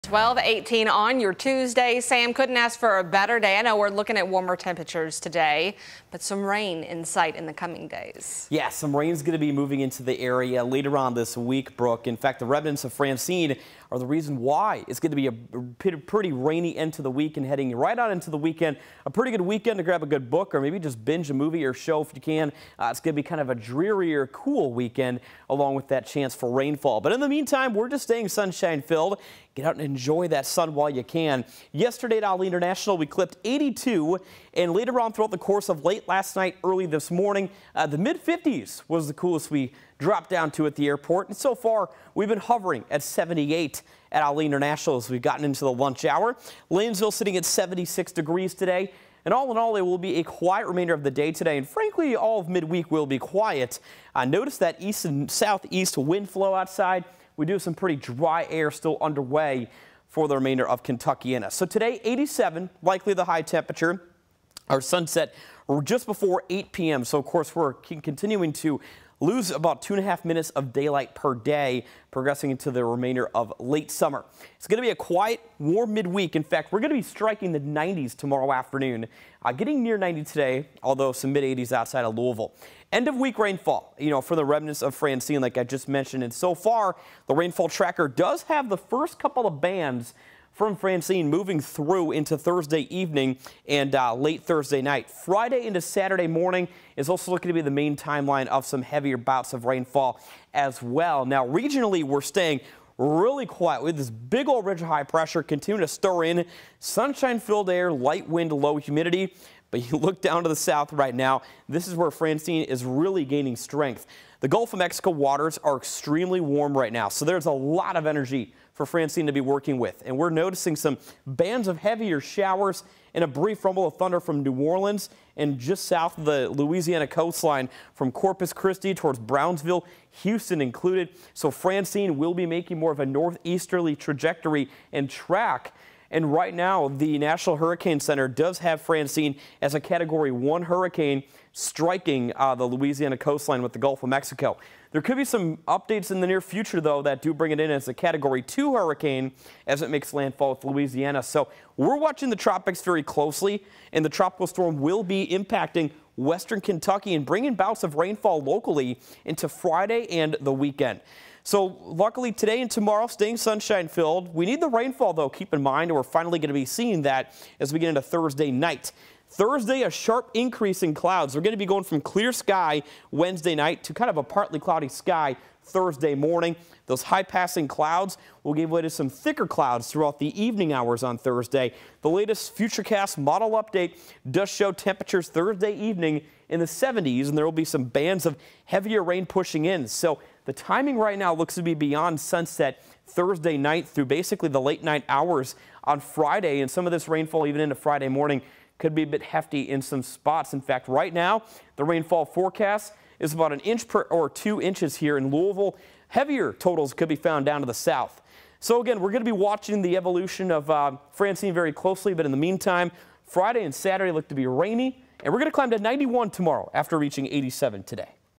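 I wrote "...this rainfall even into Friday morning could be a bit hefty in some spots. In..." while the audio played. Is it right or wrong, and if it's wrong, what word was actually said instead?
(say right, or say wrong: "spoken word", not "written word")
right.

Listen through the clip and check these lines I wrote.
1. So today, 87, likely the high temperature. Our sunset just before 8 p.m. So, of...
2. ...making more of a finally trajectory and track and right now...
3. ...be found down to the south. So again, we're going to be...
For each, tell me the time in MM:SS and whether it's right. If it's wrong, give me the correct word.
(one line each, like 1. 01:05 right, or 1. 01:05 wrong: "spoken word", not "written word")
1. 01:01 right
2. 02:12 wrong: "northeasterly", not "finally"
3. 03:27 right.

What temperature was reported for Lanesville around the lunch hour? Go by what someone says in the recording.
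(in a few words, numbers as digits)
76 degrees.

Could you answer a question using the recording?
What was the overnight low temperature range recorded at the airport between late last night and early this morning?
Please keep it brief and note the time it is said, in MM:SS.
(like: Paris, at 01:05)
mid 50s, at 00:37.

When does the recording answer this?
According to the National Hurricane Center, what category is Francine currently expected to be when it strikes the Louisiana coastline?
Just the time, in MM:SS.
02:19.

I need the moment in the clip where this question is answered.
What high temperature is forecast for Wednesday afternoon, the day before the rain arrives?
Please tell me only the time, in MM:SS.
03:35.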